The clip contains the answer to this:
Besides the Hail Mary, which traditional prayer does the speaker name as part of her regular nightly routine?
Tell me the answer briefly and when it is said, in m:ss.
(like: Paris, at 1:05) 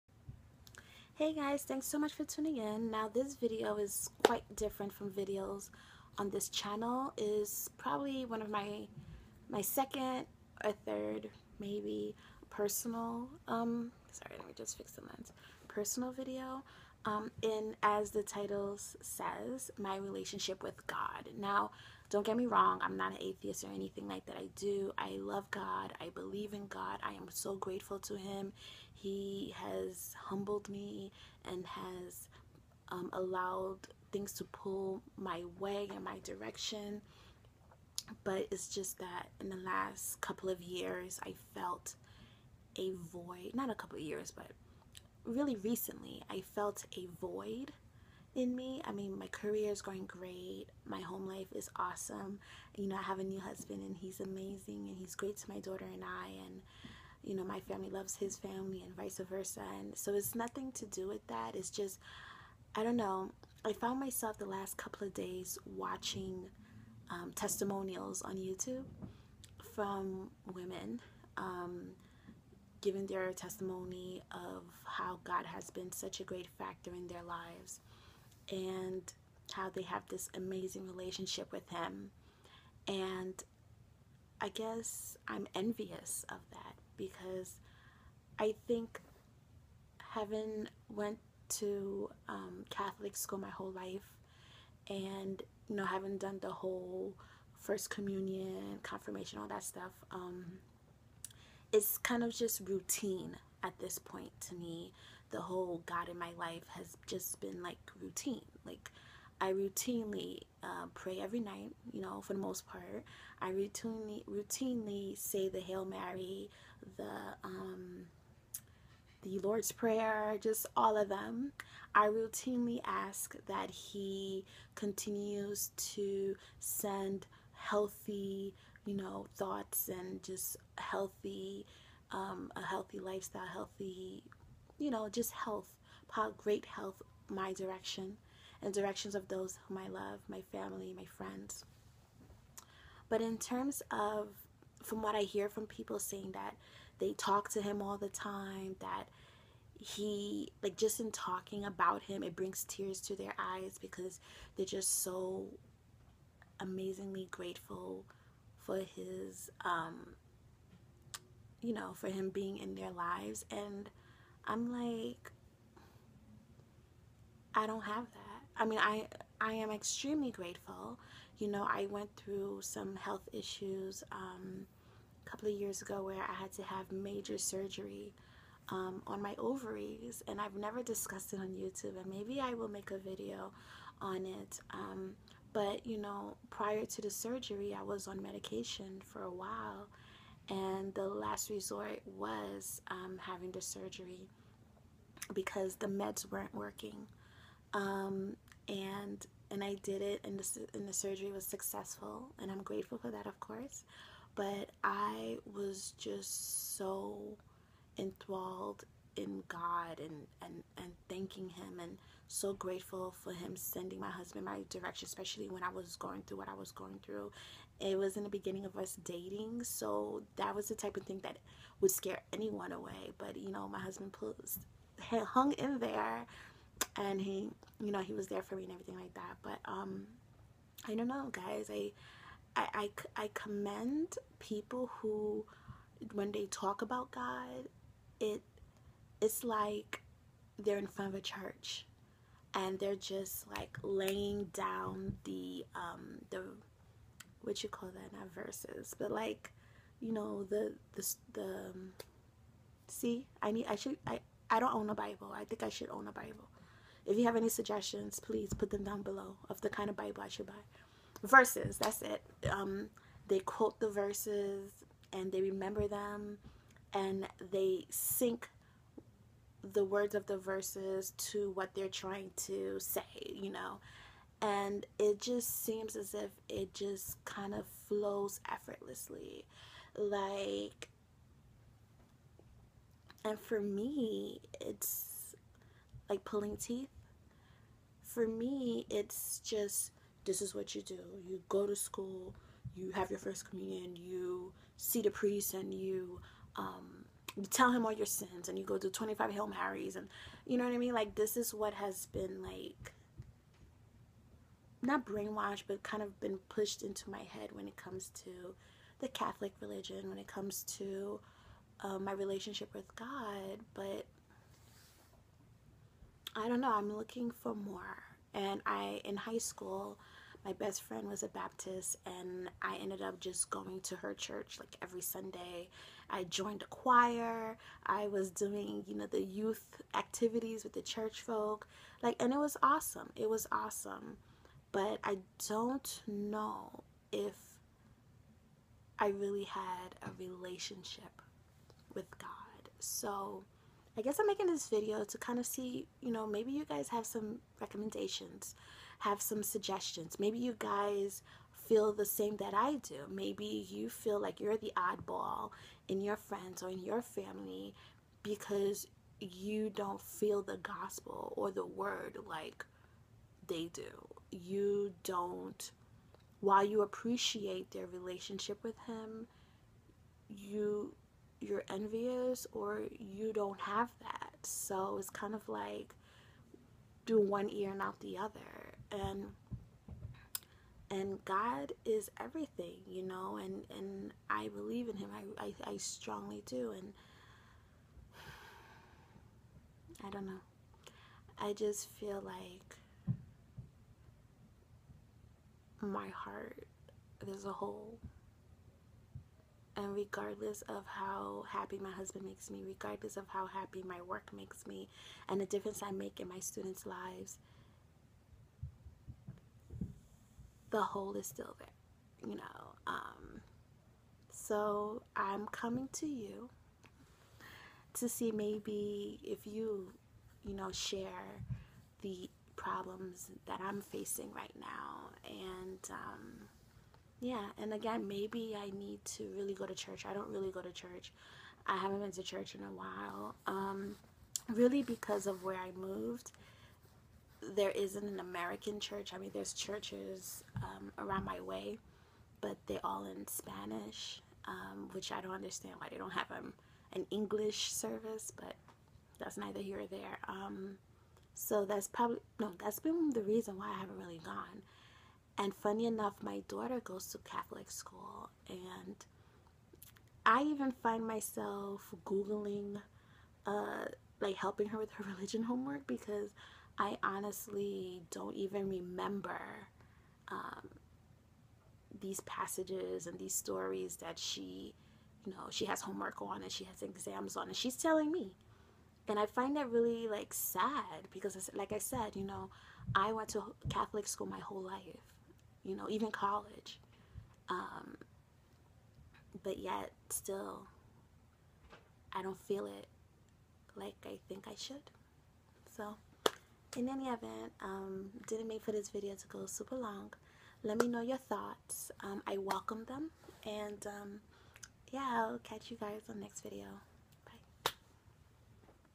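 The Lord's Prayer, at 1:59.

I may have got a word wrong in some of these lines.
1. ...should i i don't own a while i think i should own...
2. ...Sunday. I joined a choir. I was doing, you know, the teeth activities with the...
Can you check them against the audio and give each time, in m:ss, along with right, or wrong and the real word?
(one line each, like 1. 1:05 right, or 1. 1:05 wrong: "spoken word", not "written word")
1. 4:13 wrong: "bible", not "while"
2. 5:25 wrong: "youth", not "teeth".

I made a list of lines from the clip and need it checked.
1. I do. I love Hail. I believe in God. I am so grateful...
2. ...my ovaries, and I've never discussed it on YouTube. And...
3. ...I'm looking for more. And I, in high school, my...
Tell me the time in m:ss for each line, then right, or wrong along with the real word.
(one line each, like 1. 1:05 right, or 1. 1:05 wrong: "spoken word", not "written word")
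1. 0:24 wrong: "God", not "Hail"
2. 2:59 right
3. 5:16 right.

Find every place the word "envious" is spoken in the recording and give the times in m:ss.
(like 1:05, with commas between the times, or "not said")
1:25, 6:11.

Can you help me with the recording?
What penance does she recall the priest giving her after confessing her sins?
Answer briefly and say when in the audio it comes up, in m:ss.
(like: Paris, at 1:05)
25 Hail Marys, at 4:58.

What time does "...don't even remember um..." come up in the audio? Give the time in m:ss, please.
7:48.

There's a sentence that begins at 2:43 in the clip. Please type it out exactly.
And I'm like, I don't have that.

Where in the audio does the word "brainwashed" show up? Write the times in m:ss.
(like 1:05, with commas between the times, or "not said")
5:05.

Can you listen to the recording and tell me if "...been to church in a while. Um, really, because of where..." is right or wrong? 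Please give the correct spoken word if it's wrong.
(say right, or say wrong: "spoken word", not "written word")
right.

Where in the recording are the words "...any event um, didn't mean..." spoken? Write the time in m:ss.
8:16.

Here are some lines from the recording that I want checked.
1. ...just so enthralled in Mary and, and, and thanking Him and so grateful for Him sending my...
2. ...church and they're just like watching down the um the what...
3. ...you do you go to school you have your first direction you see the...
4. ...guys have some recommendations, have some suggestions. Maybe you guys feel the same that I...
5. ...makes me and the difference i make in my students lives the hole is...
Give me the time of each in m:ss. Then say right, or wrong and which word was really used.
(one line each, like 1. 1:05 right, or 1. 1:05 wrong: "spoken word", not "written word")
1. 3:25 wrong: "God", not "Mary"
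2. 4:01 wrong: "laying", not "watching"
3. 4:50 wrong: "communion", not "direction"
4. 5:46 right
5. 6:44 right.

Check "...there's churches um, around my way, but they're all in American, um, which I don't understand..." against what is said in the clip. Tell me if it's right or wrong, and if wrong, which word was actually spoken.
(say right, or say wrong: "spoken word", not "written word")
wrong: "Spanish", not "American".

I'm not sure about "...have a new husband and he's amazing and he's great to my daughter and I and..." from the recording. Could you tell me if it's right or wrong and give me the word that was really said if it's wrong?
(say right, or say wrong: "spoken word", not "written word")
right.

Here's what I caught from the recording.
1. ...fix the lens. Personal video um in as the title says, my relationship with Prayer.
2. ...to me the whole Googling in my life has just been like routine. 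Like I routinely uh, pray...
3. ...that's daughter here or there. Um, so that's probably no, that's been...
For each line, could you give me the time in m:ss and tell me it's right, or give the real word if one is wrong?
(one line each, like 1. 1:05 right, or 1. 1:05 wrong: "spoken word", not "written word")
1. 0:14 wrong: "God", not "Prayer"
2. 1:44 wrong: "God", not "Googling"
3. 7:29 wrong: "neither", not "daughter".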